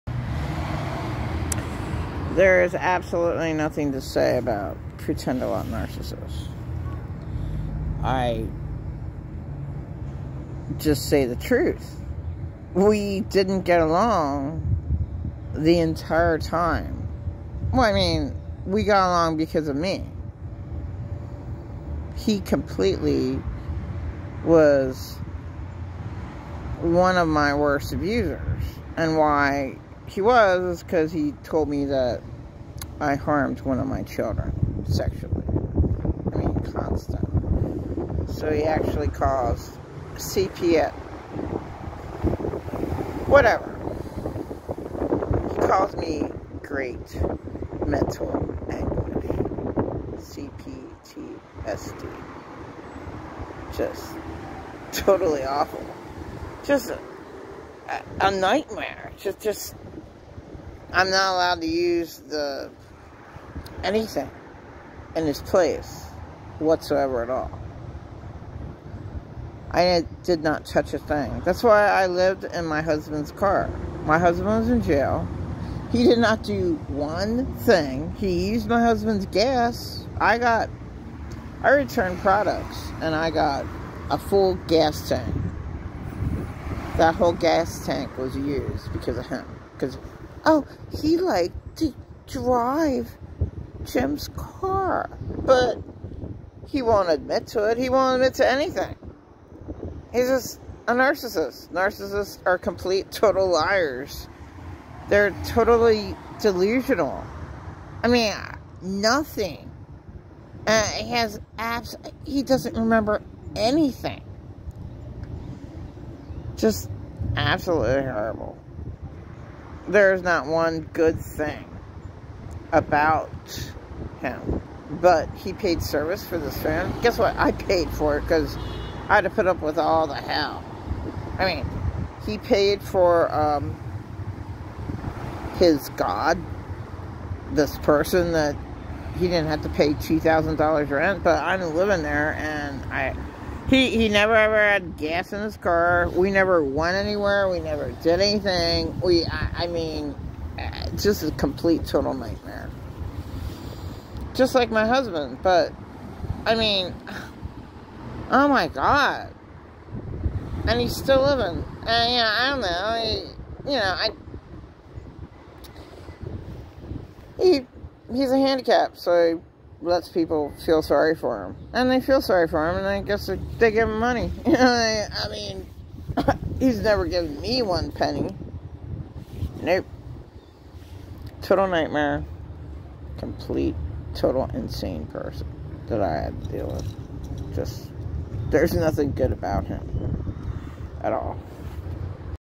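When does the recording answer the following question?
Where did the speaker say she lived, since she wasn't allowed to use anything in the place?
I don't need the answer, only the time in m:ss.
1:12.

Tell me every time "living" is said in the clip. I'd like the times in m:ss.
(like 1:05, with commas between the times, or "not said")
2:21, 2:41.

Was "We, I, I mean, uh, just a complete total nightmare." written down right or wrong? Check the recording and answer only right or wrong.
right.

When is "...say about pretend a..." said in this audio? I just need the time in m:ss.
0:03.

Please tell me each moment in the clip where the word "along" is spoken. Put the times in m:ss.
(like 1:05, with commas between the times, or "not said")
0:13, 0:19.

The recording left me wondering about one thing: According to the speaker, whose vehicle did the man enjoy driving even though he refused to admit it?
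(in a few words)
Jim's.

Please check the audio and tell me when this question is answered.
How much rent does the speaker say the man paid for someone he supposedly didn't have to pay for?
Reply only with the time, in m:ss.
2:19.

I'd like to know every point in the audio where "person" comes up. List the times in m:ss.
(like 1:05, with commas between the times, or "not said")
2:17, 3:05.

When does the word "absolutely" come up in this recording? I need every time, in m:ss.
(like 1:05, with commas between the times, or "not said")
0:02, 1:57.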